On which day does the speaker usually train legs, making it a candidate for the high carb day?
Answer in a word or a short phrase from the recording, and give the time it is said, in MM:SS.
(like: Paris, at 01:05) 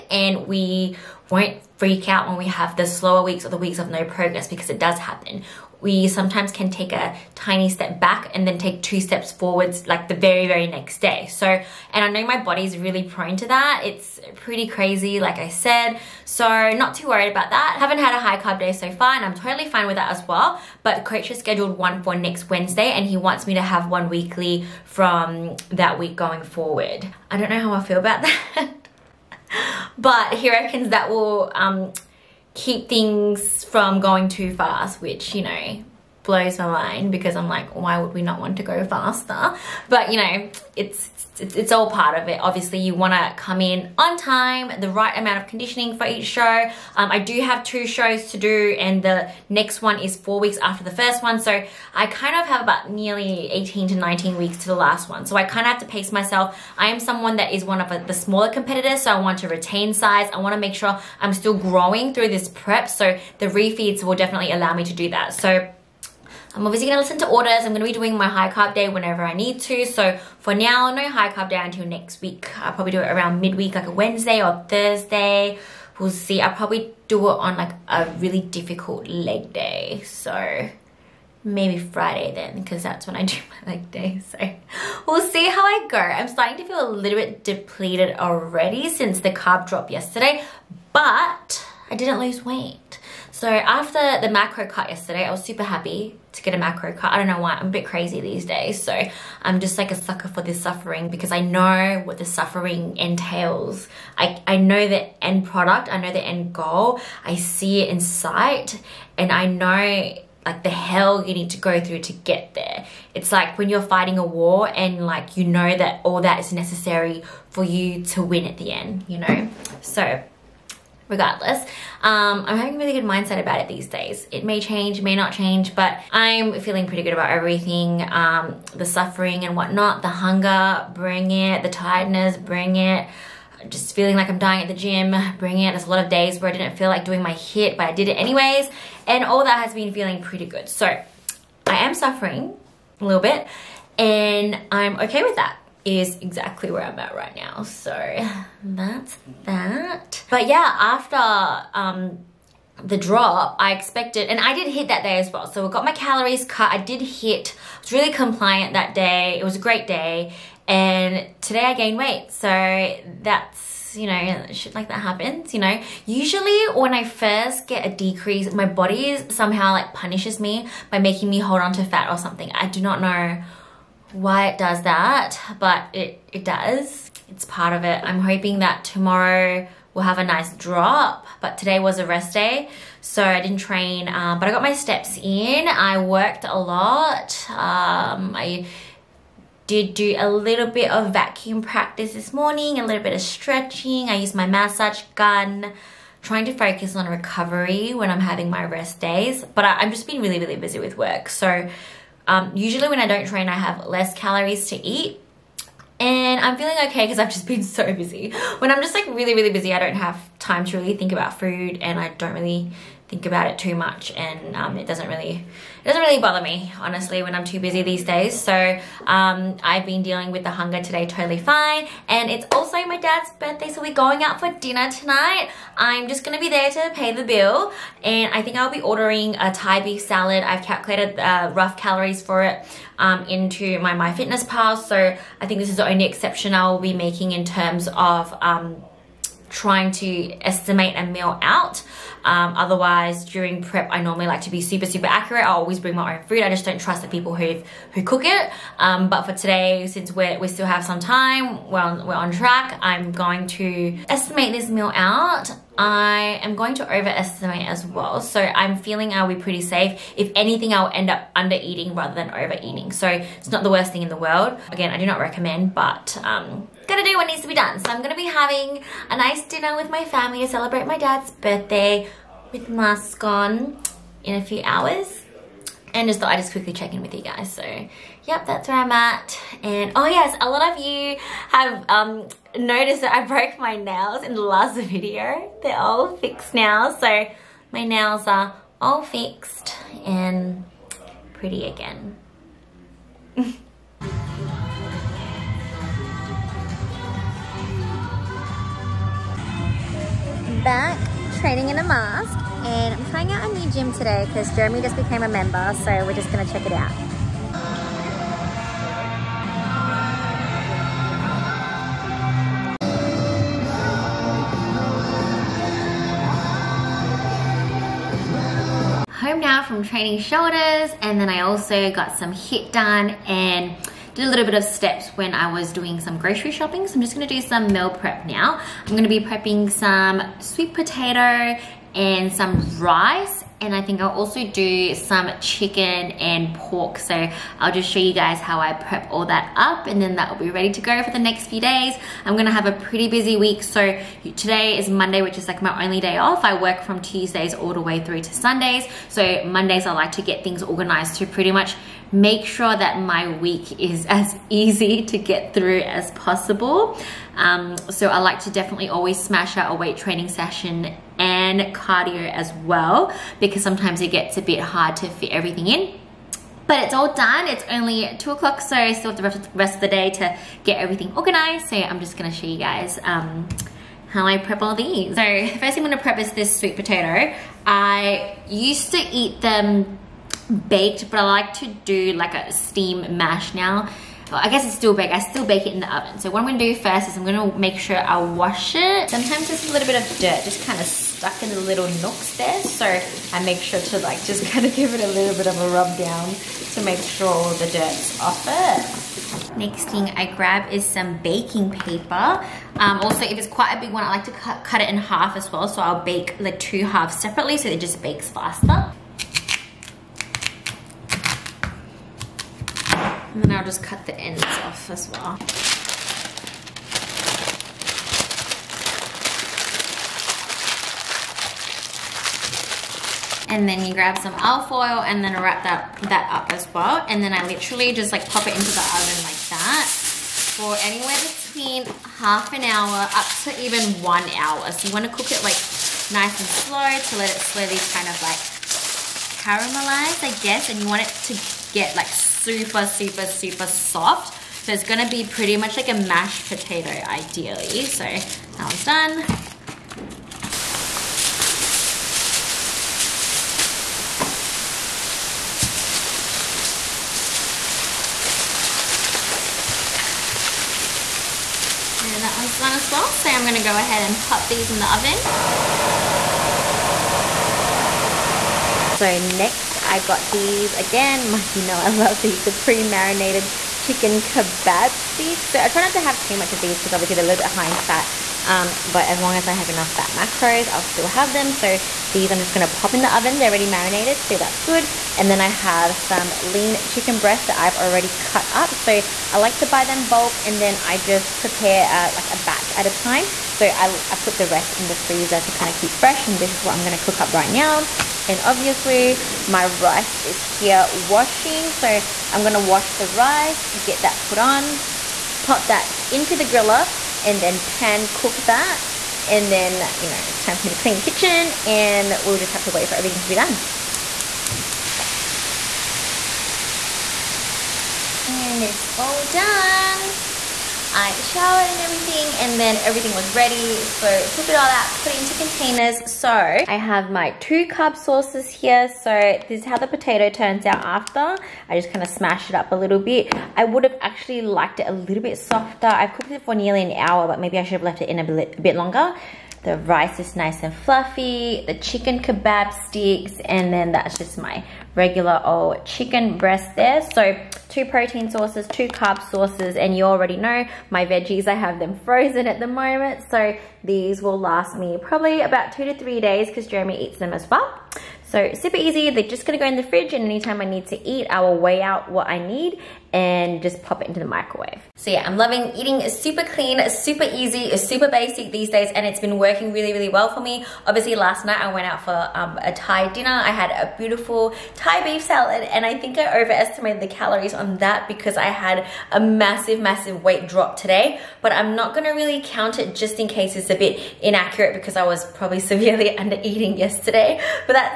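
Friday, at 01:20.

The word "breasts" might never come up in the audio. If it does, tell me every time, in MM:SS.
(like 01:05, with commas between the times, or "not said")
08:07, 09:06.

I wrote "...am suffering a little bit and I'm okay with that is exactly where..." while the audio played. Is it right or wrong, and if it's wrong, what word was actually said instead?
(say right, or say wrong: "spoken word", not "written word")
right.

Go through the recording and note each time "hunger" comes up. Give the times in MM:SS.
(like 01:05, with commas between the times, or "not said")
02:10, 03:40.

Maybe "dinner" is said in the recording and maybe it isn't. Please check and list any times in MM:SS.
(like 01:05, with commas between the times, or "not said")
03:44, 04:29, 09:33.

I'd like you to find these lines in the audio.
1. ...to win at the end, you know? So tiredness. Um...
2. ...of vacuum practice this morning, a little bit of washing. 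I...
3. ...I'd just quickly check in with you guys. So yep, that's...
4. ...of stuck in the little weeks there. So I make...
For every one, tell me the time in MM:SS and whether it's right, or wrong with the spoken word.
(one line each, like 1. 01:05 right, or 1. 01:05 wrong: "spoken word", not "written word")
1. 01:58 wrong: "regardless", not "tiredness"
2. 03:10 wrong: "stretching", not "washing"
3. 04:36 right
4. 06:30 wrong: "nooks", not "weeks".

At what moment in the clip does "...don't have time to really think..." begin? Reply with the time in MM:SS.
03:29.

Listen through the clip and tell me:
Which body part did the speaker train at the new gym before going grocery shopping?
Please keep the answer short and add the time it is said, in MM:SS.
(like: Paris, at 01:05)
Shoulders, at 05:20.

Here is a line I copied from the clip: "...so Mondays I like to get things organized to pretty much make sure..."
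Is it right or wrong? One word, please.
right.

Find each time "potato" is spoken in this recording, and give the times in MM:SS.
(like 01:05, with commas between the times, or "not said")
05:30, 06:16, 07:26, 08:49.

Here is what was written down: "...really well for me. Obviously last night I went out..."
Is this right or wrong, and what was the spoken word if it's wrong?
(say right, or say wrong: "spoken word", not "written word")
right.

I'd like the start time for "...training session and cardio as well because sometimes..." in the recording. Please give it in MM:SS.
05:59.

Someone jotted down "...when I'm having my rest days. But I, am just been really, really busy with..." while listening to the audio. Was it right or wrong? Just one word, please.
right.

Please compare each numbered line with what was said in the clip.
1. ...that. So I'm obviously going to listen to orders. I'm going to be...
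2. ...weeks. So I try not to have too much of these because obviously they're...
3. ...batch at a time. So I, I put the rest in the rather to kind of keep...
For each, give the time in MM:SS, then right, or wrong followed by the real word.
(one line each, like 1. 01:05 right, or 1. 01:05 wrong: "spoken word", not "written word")
1. 01:05 right
2. 07:55 wrong: "sticks", not "weeks"
3. 08:12 wrong: "freezer", not "rather".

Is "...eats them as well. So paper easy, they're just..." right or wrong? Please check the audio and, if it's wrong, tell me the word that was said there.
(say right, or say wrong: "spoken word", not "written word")
wrong: "super", not "paper".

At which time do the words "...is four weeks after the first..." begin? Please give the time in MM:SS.
00:49.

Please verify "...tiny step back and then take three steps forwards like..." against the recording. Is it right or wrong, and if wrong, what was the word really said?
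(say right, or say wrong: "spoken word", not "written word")
wrong: "two", not "three".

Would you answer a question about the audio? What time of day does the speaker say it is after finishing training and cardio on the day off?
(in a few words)
2 o'clock.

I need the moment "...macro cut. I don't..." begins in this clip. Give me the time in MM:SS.
01:36.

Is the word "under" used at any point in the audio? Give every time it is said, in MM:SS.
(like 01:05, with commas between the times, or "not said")
04:21, 09:46.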